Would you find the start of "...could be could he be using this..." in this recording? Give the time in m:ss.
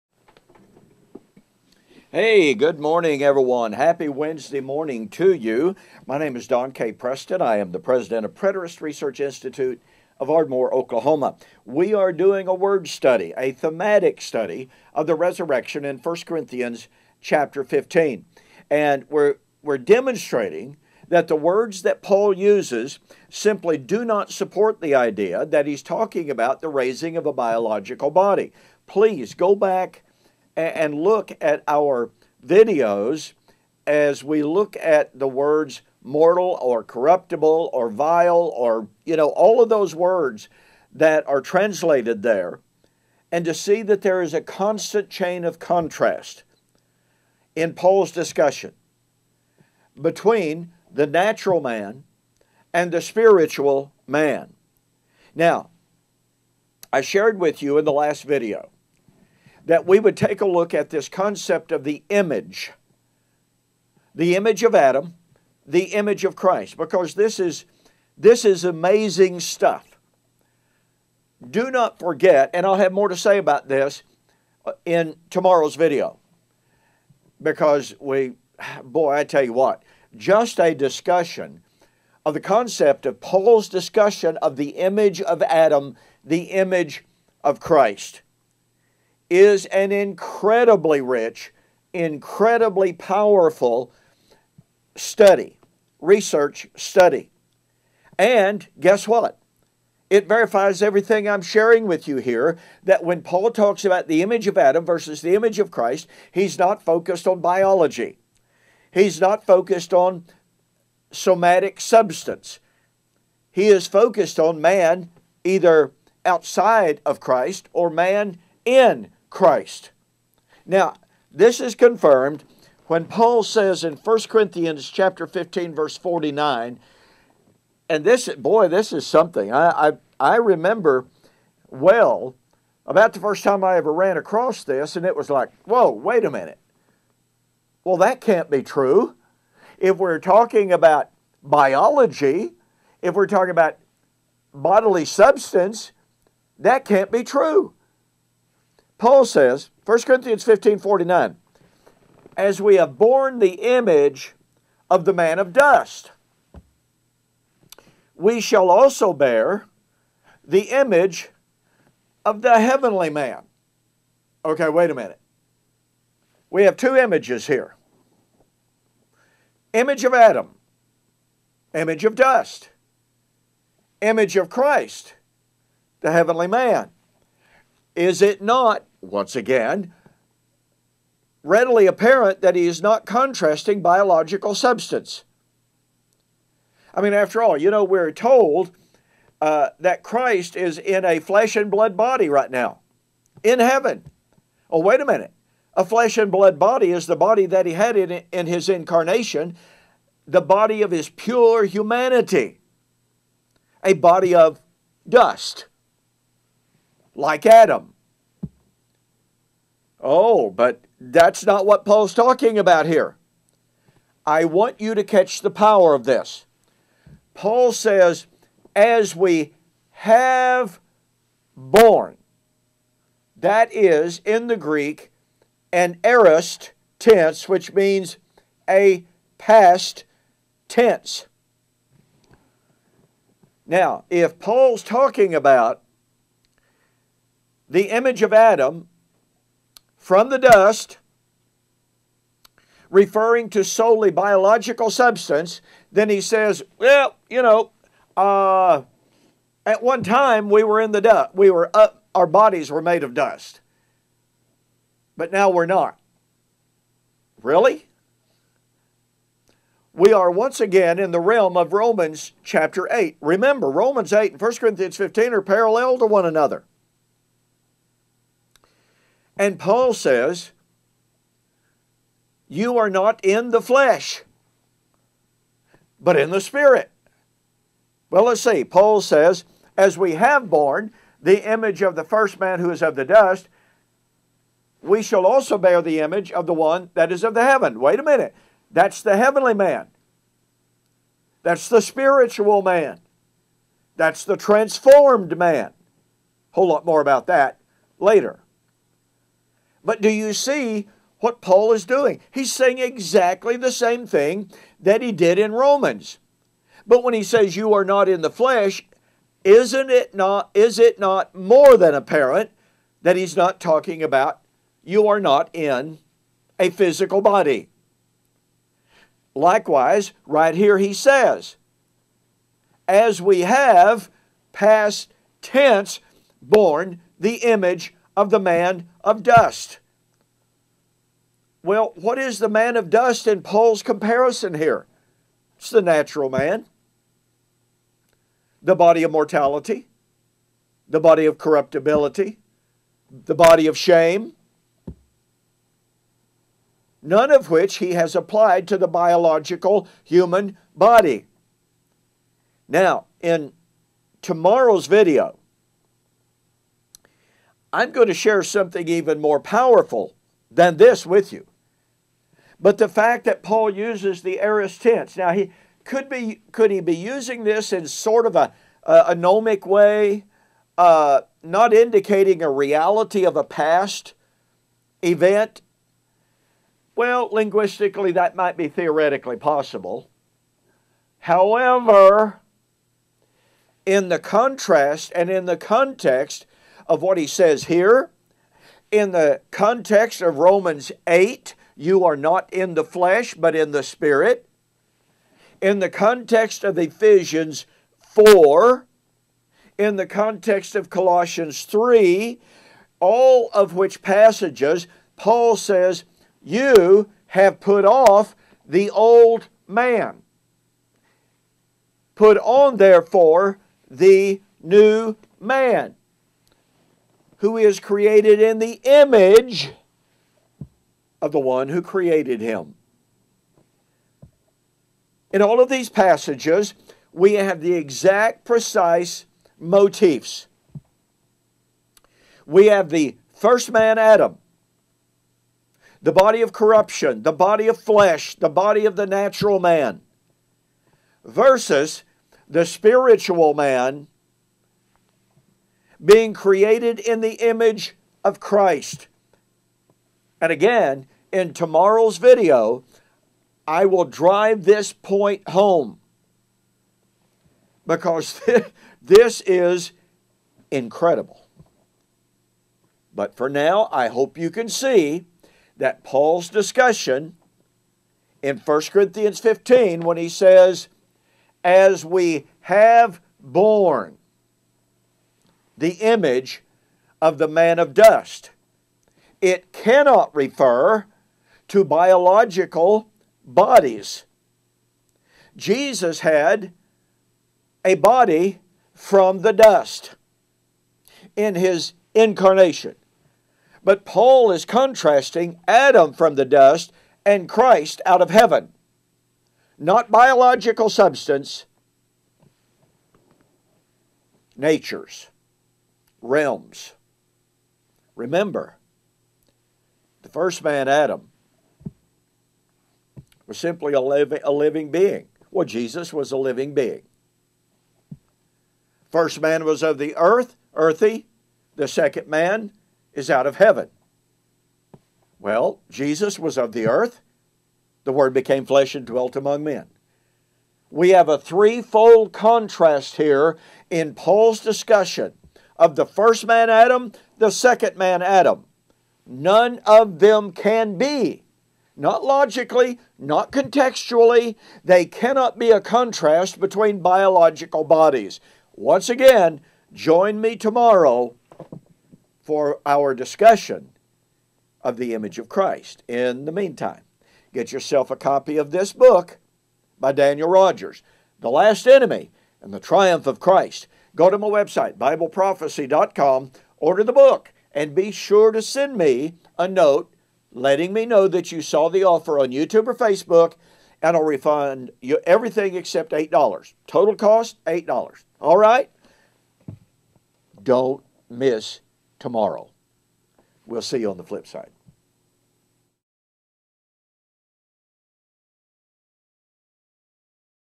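6:05.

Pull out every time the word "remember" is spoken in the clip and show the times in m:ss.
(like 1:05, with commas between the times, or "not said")
2:10, 4:23, 8:28.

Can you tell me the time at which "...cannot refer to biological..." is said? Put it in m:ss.
7:59.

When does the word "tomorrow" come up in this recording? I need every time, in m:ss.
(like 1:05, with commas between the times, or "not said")
1:15, 5:54, 7:31, 9:10, 9:42.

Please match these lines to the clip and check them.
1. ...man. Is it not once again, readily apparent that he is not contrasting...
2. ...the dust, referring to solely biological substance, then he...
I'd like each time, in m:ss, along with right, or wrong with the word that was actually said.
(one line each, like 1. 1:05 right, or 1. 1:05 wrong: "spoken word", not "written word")
1. 2:56 right
2. 4:00 right.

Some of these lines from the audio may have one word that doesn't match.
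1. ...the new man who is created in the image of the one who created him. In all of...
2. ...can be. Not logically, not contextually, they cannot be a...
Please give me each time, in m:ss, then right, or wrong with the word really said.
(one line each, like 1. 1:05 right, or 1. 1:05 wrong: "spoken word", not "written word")
1. 6:53 right
2. 9:00 right.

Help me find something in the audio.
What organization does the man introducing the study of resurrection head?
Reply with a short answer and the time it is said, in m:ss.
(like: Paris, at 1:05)
Preterist Research Institute, at 0:08.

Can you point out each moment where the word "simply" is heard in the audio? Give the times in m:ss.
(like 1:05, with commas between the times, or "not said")
0:23, 8:33.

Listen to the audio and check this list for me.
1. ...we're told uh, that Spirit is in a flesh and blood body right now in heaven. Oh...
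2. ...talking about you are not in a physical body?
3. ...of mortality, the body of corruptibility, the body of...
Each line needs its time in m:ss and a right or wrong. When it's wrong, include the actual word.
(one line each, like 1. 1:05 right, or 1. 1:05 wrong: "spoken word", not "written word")
1. 3:07 wrong: "Christ", not "Spirit"
2. 5:13 right
3. 5:39 right.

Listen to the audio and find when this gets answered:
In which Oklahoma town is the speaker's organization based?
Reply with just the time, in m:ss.
0:10.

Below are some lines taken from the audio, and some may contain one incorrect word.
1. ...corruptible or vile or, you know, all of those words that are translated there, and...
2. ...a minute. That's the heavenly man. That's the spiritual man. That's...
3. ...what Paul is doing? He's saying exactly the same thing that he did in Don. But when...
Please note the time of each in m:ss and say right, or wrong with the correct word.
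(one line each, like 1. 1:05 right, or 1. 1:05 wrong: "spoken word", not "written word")
1. 0:36 right
2. 4:47 right
3. 5:01 wrong: "Romans", not "Don".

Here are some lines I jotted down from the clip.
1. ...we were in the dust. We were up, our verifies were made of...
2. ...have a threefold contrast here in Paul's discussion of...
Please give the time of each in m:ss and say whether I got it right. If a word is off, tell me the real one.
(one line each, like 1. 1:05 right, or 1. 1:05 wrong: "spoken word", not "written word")
1. 4:10 wrong: "bodies", not "verifies"
2. 8:51 right.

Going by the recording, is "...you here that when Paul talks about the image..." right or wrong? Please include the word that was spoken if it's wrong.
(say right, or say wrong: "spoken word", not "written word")
right.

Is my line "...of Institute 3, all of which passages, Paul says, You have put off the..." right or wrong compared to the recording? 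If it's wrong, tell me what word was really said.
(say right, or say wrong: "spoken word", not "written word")
wrong: "Colossians", not "Institute".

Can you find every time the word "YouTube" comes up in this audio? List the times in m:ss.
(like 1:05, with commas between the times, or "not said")
9:32.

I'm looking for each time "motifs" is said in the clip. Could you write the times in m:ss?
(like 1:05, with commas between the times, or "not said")
7:09.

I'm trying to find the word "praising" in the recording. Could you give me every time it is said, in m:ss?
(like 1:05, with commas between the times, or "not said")
not said.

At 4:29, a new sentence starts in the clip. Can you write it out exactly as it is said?
And Paul says, You are not in the flesh, but in the Spirit.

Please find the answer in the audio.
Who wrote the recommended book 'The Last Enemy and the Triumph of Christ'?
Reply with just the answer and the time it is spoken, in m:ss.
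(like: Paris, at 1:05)
Daniel Rogers, at 9:20.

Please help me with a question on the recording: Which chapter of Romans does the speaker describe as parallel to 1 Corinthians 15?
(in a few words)
Romans 8.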